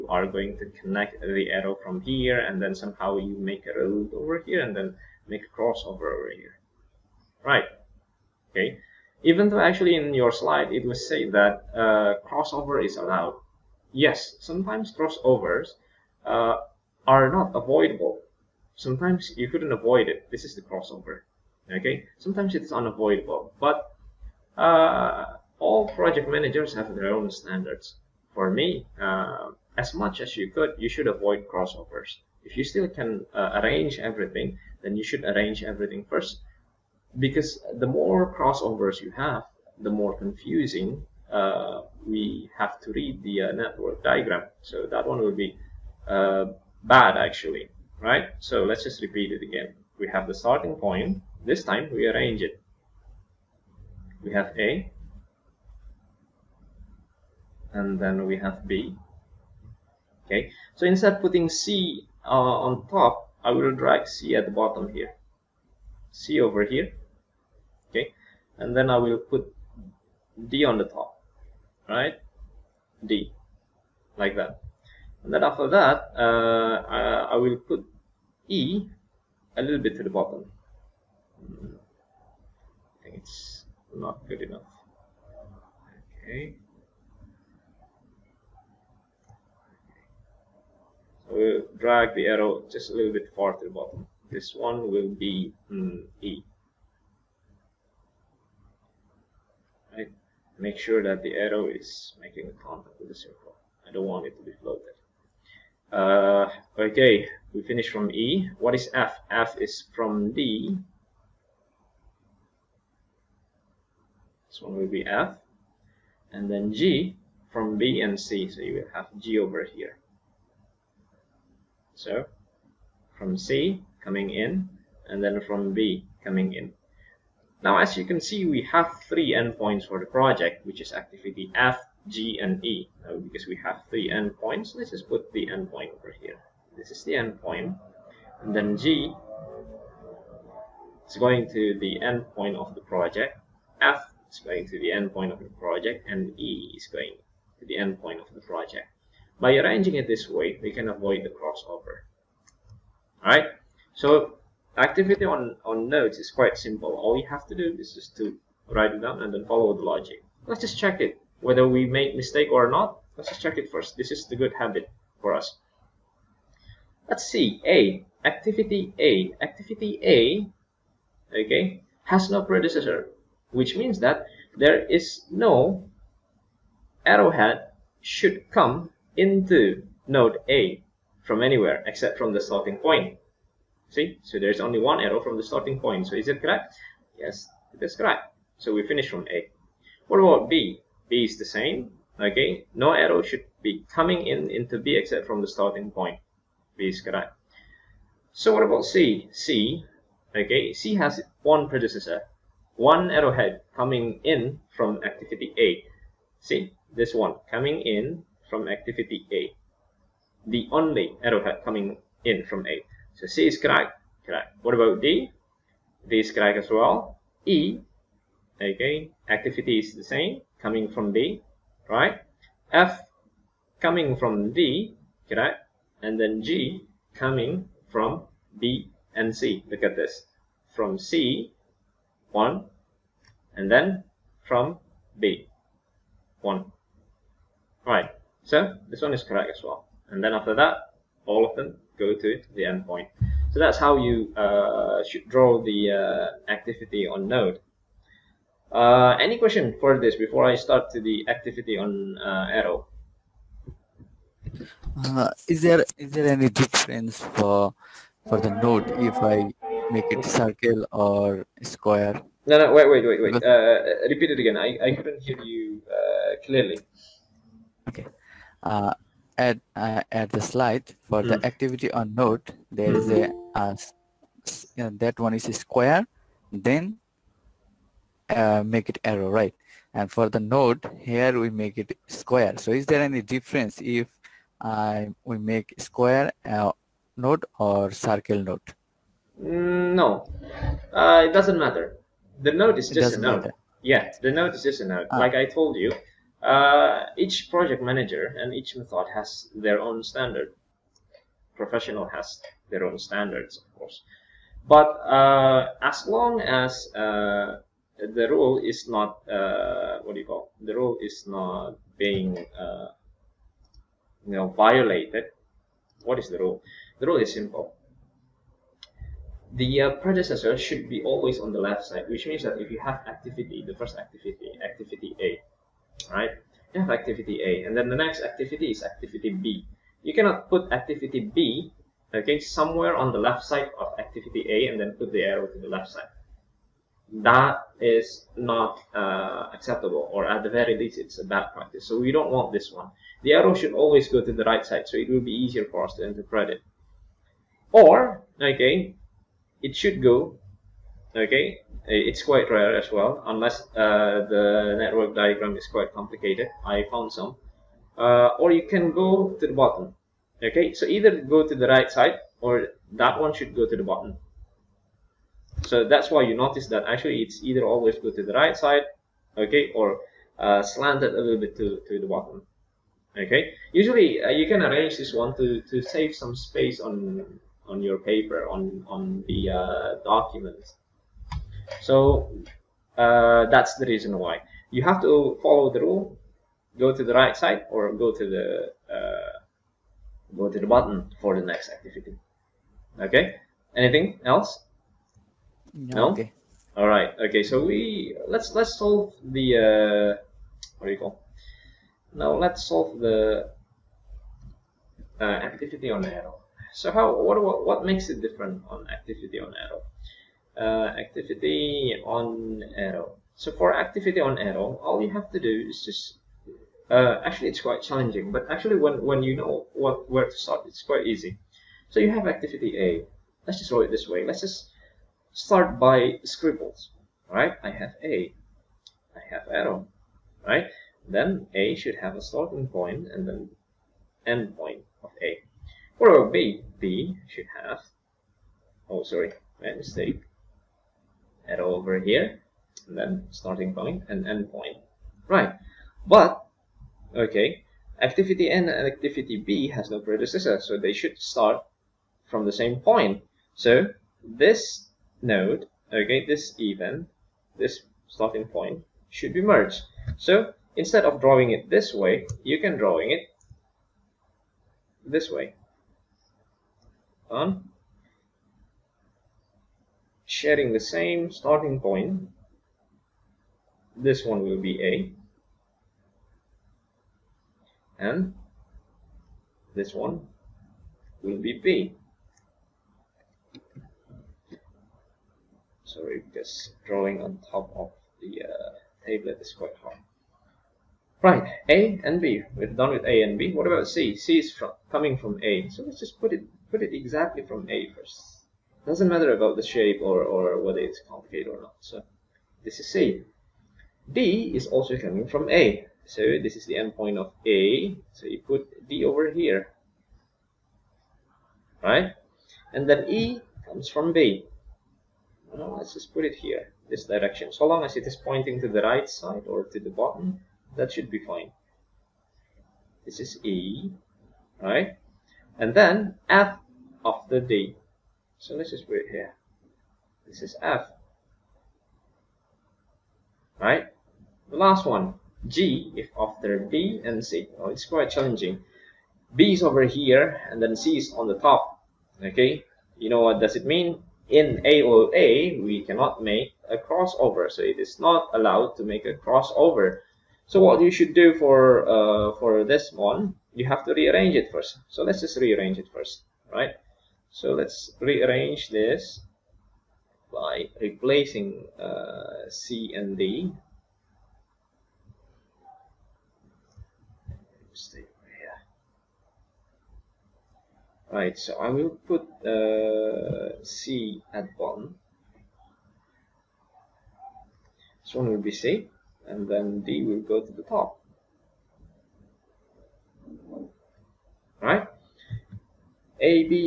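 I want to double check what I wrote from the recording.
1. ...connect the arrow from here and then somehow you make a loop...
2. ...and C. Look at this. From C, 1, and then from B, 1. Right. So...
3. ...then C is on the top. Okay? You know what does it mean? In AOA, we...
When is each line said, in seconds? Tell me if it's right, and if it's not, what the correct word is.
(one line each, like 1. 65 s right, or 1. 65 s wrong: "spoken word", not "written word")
1. 0 s right
2. 229 s right
3. 540 s right.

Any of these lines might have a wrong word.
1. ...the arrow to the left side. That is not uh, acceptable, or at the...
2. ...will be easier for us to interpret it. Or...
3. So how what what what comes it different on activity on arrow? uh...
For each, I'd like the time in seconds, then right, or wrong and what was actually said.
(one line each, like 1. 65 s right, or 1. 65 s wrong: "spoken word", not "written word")
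1. 335 s right
2. 345 s right
3. 406 s wrong: "makes", not "comes".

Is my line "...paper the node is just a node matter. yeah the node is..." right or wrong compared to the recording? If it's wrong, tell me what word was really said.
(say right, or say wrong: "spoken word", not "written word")
wrong: "matter", not "paper".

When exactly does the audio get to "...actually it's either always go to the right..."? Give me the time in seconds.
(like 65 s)
366 s.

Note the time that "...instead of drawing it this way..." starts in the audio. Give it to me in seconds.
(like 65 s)
460 s.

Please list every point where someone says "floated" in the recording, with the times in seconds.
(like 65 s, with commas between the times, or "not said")
104 s.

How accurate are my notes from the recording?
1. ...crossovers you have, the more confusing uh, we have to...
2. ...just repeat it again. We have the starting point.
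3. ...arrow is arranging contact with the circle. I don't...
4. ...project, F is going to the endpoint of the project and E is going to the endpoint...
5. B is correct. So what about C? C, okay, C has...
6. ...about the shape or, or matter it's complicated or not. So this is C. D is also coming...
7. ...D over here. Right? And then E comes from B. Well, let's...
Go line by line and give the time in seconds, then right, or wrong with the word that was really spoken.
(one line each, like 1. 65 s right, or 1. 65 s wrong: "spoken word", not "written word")
1. 38 s right
2. 48 s right
3. 101 s wrong: "making", not "arranging"
4. 142 s right
5. 196 s right
6. 499 s wrong: "whether", not "matter"
7. 508 s right.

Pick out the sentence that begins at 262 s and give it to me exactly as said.
No, no, wait, wait, wait, wait.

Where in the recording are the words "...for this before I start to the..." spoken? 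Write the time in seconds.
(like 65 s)
249 s.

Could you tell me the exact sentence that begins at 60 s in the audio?
Okay, so instead of putting C uh, on top, I will drag C at the bottom here.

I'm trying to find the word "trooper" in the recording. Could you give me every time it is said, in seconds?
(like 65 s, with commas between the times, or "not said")
not said.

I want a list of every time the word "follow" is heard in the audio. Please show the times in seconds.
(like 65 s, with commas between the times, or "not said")
159 s, 385 s.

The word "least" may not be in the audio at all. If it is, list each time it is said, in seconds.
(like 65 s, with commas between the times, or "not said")
340 s.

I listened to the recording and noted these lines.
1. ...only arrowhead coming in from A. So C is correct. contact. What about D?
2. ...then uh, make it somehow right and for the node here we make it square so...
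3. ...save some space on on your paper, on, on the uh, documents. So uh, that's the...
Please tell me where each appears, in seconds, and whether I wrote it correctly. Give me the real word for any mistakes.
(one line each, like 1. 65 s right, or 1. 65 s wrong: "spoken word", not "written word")
1. 210 s wrong: "correct", not "contact"
2. 276 s wrong: "arrow", not "somehow"
3. 375 s right.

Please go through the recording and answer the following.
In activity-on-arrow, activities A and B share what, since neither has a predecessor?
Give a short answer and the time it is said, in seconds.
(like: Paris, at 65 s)
Same starting point, at 470 s.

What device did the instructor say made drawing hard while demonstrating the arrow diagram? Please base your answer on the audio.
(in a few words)
Tablet.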